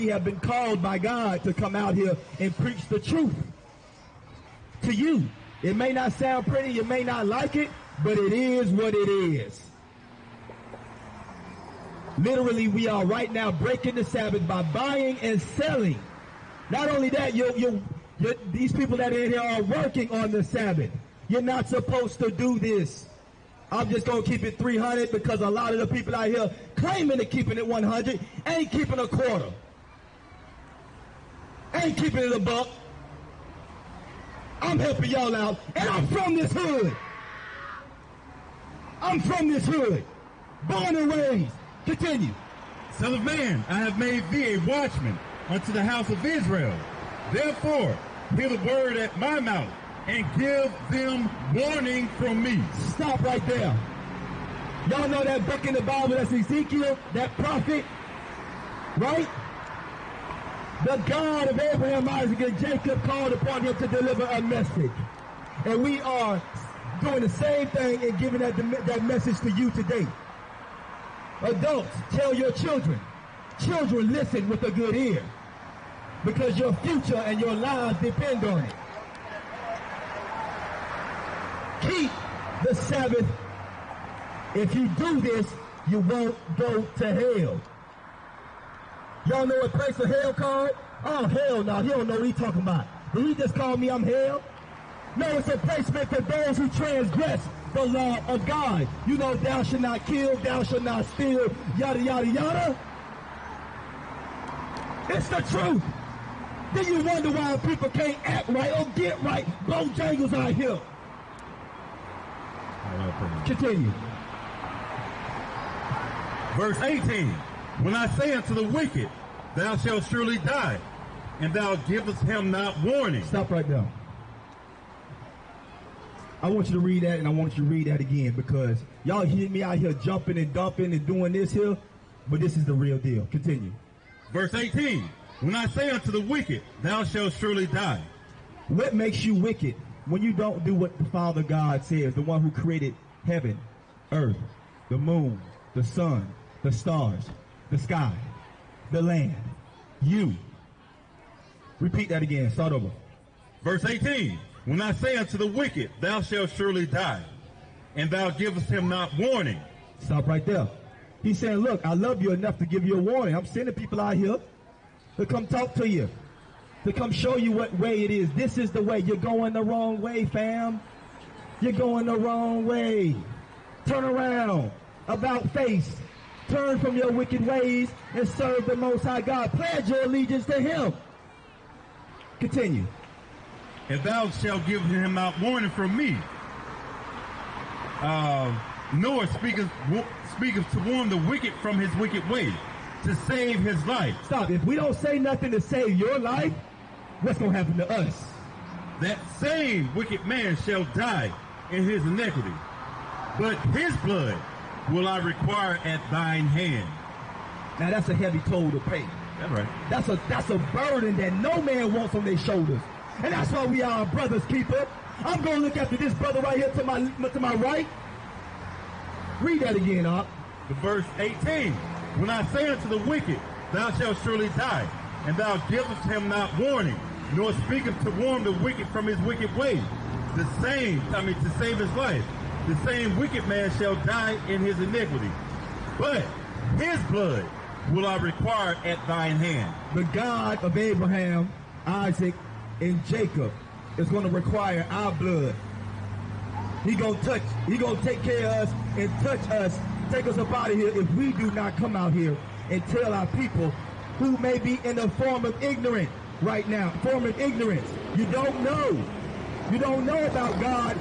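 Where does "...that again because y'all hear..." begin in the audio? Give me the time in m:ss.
2:07.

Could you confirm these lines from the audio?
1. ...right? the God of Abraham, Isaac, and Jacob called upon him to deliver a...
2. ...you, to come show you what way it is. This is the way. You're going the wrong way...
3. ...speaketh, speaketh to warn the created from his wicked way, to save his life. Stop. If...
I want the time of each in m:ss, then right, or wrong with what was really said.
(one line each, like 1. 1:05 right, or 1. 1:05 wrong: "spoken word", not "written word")
1. 0:58 right
2. 2:45 right
3. 3:09 wrong: "wicked", not "created".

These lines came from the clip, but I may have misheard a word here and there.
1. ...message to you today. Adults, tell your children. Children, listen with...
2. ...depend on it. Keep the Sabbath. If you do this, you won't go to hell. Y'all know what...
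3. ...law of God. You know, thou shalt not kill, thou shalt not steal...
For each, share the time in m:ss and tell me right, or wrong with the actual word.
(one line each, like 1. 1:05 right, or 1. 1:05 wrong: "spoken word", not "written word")
1. 1:09 right
2. 1:18 right
3. 1:37 right.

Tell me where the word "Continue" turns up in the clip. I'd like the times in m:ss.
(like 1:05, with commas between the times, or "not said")
0:41, 1:53, 2:13, 3:02.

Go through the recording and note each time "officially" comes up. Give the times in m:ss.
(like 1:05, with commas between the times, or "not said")
not said.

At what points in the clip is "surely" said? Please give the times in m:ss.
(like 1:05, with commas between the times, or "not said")
2:00, 2:17, 2:36, 3:44.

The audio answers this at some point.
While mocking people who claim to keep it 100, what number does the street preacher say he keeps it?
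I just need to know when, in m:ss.
0:24.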